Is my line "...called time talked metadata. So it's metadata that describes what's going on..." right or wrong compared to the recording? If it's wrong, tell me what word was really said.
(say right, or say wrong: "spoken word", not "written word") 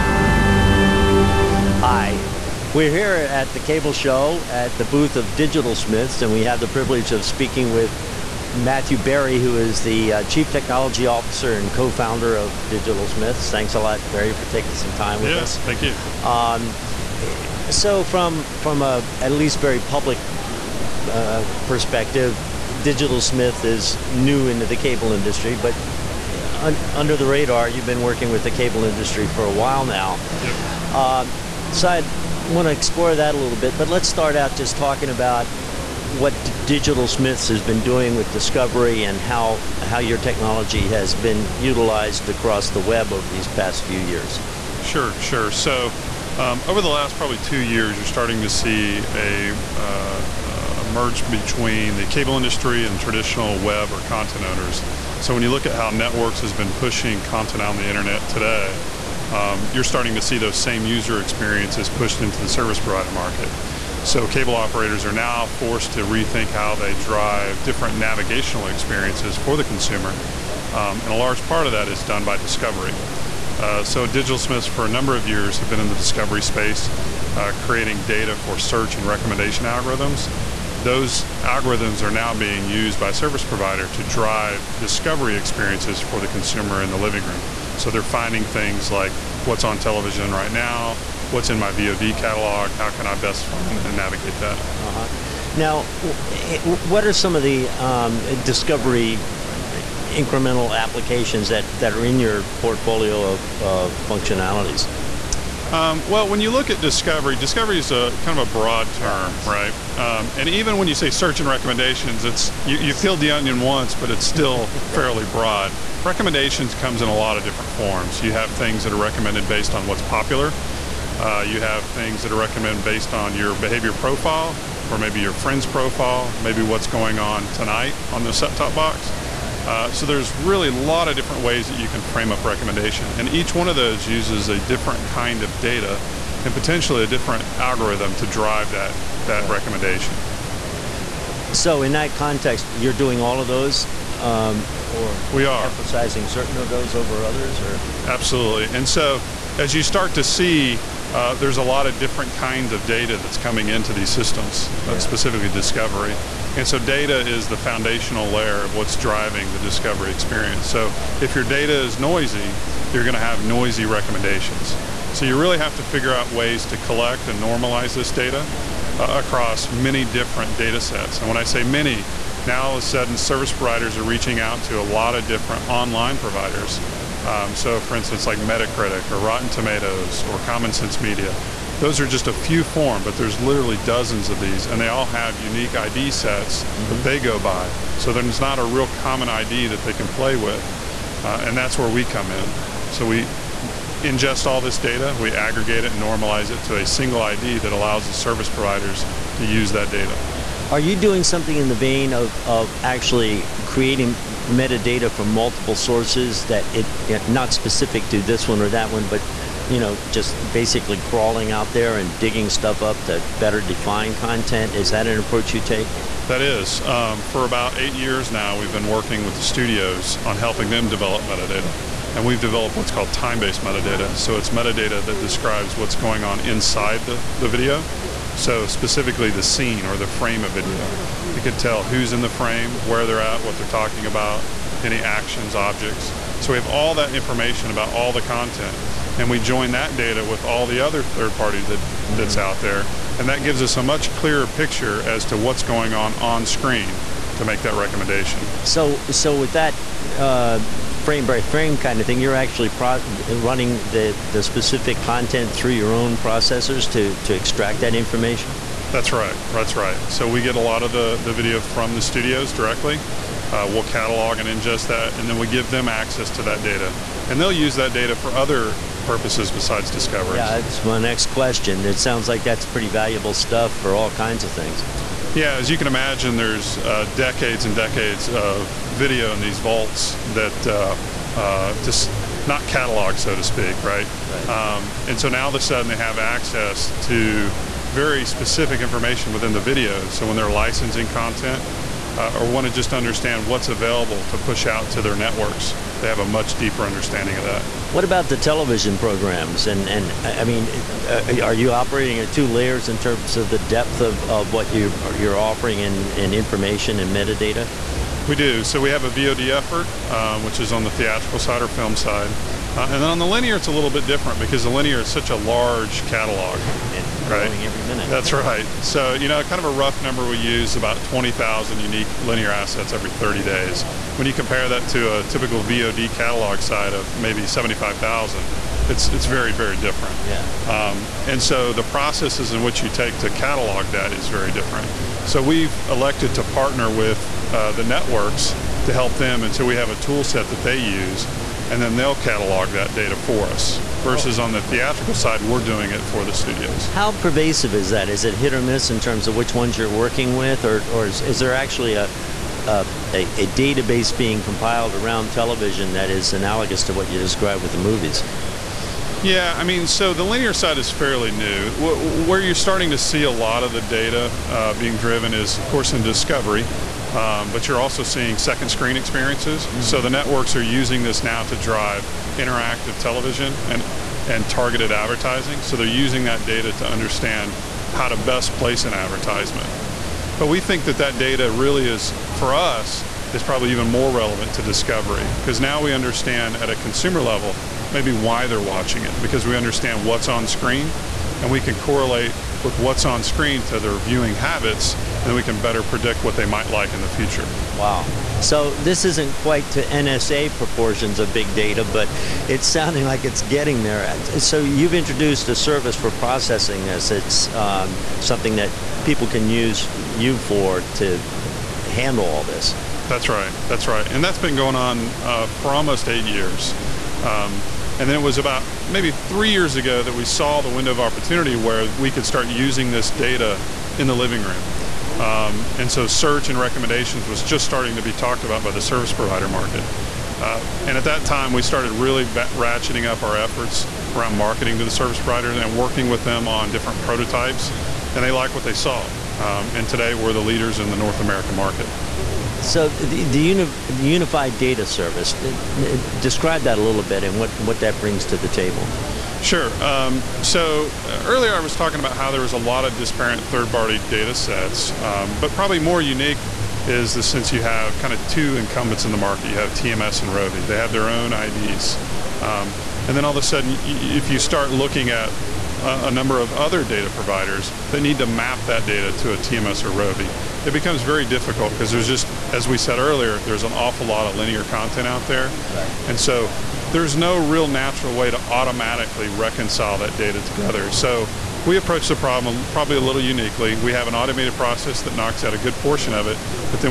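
wrong: "based", not "talked".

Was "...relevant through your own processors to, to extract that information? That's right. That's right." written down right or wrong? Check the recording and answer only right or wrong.
wrong.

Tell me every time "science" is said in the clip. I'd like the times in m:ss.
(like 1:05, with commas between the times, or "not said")
not said.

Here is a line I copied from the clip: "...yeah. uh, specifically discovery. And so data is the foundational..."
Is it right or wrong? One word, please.
right.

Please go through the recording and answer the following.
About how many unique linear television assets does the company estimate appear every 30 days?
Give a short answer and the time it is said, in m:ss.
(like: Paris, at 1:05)
20,000, at 5:21.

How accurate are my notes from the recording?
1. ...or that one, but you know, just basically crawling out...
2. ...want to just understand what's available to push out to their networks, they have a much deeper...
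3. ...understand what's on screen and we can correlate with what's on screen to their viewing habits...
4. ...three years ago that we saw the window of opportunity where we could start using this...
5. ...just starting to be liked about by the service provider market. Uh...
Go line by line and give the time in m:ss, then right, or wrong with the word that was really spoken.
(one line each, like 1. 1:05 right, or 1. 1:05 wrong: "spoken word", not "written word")
1. 3:28 right
2. 4:52 right
3. 6:29 right
4. 6:59 right
5. 7:07 wrong: "talked", not "liked".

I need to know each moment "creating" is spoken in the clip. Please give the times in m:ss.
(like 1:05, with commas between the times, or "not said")
1:17, 3:23.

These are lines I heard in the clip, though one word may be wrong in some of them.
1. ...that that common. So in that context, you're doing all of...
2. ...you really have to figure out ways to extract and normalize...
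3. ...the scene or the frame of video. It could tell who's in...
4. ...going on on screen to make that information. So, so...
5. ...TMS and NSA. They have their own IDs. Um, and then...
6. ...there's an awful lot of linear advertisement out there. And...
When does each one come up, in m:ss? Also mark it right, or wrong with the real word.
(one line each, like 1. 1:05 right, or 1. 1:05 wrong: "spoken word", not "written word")
1. 2:18 wrong: "recommendation", not "common"
2. 2:45 wrong: "collect", not "extract"
3. 3:49 right
4. 4:05 wrong: "recommendation", not "information"
5. 7:39 wrong: "Rovi", not "NSA"
6. 7:53 wrong: "content", not "advertisement".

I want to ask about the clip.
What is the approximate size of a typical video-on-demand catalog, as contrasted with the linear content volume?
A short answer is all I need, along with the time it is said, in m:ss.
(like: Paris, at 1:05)
75,000, at 5:27.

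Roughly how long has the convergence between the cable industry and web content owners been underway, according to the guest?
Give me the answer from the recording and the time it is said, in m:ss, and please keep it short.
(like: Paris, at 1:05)
2 years, at 0:47.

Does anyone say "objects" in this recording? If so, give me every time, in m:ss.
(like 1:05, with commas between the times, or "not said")
3:55.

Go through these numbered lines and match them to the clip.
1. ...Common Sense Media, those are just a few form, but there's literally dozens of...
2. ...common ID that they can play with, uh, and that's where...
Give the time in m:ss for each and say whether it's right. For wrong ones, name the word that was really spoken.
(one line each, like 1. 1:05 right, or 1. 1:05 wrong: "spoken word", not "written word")
1. 3:00 right
2. 3:08 right.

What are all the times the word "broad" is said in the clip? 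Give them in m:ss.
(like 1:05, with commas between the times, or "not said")
1:48, 1:55.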